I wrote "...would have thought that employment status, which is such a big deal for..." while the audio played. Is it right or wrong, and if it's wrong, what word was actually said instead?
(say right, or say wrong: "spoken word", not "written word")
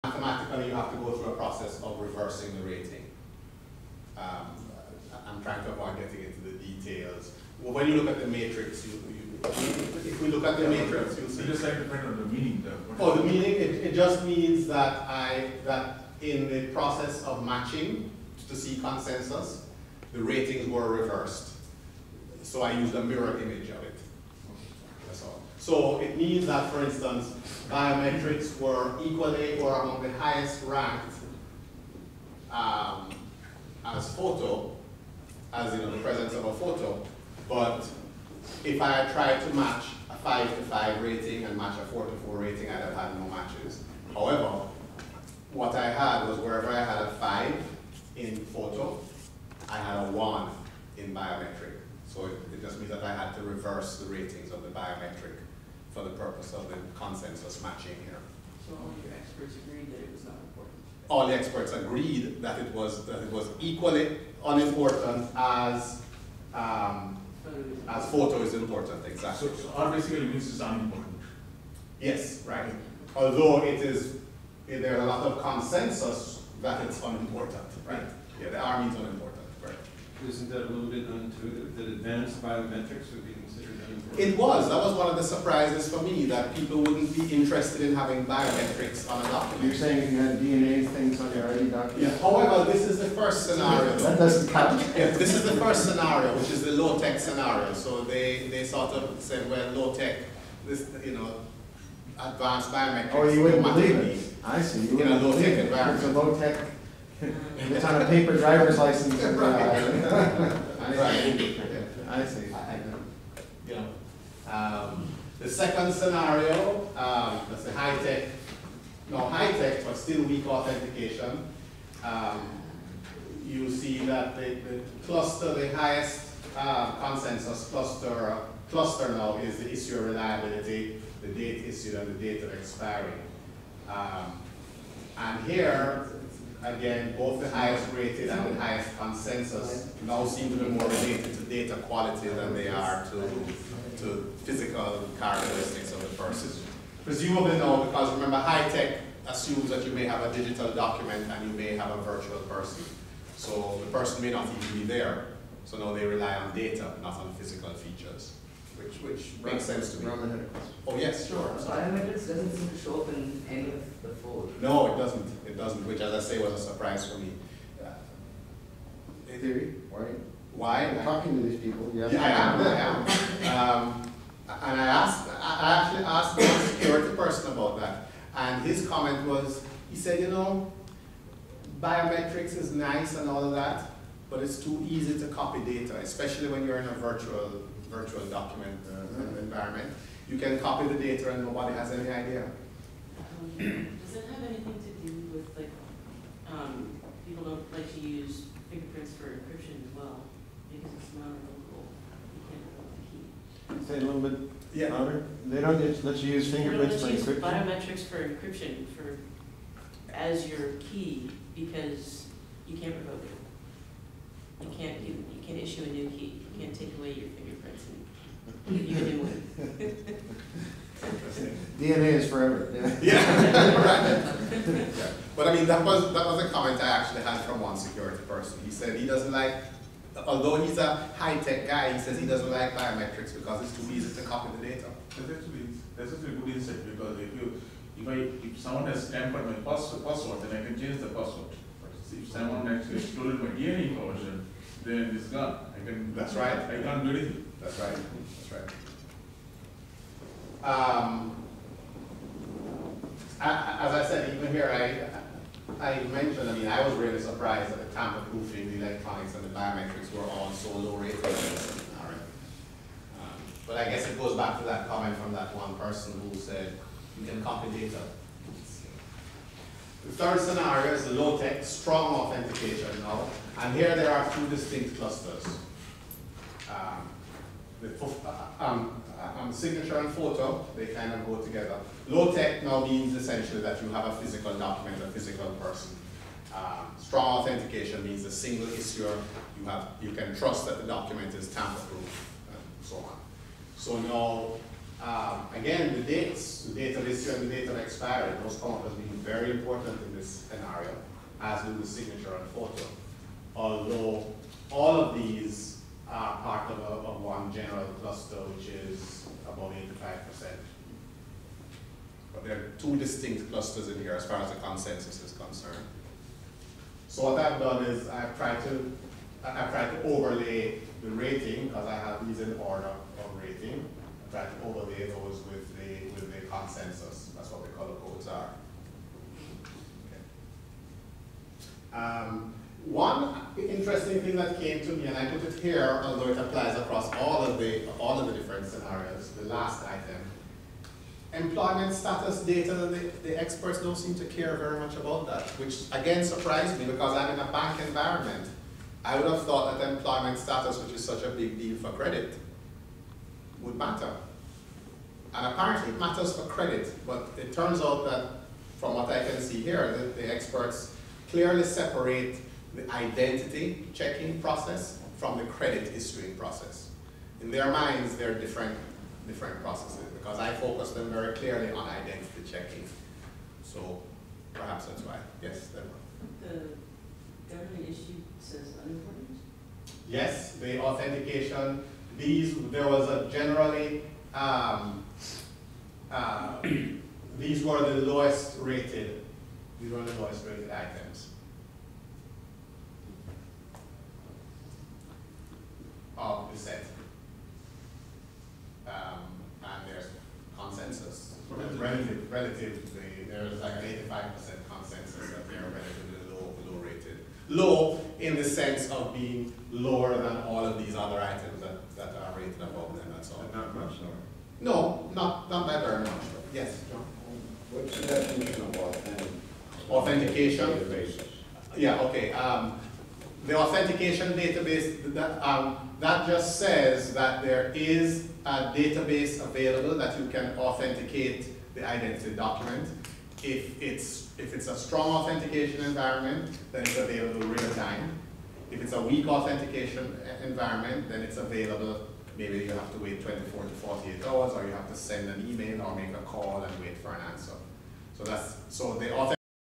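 right.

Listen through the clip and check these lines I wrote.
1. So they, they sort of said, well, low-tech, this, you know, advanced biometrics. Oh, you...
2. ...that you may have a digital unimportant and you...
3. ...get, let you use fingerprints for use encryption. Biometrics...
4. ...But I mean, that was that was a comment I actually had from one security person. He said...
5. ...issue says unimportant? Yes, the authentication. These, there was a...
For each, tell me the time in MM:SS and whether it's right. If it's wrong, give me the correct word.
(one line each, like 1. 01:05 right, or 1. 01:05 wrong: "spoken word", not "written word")
1. 01:37 right
2. 02:29 wrong: "document", not "unimportant"
3. 03:25 right
4. 03:45 right
5. 06:17 right.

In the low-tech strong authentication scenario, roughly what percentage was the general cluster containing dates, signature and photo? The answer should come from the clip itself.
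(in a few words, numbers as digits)
85%.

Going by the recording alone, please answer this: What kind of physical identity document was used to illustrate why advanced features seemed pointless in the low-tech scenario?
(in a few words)
Paper driver's license.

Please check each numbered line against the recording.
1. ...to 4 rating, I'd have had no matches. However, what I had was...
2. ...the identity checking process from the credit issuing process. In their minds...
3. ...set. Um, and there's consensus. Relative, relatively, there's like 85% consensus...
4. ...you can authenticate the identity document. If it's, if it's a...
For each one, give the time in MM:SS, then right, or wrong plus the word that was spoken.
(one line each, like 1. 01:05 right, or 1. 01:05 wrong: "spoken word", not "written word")
1. 00:42 right
2. 06:02 right
3. 06:36 right
4. 07:10 right.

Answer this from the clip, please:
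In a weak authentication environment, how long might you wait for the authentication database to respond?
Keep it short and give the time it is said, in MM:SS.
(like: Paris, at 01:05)
24 to 48 hours, at 07:23.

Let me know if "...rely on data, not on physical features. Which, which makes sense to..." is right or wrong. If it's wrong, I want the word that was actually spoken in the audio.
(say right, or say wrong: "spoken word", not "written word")
right.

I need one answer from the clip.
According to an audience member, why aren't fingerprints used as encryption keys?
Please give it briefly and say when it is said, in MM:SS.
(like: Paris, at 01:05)
Revoke the key, at 03:22.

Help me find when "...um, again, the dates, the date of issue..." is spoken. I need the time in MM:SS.
04:55.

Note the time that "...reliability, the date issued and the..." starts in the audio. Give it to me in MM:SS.
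02:10.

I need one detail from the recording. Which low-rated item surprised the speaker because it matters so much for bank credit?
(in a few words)
Employment status data.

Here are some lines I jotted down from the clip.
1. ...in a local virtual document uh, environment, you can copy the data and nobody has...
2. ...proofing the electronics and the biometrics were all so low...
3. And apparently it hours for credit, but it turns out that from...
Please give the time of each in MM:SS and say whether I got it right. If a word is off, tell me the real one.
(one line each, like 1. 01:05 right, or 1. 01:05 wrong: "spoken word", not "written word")
1. 03:06 wrong: "virtual", not "local"
2. 04:18 right
3. 05:55 wrong: "matters", not "hours".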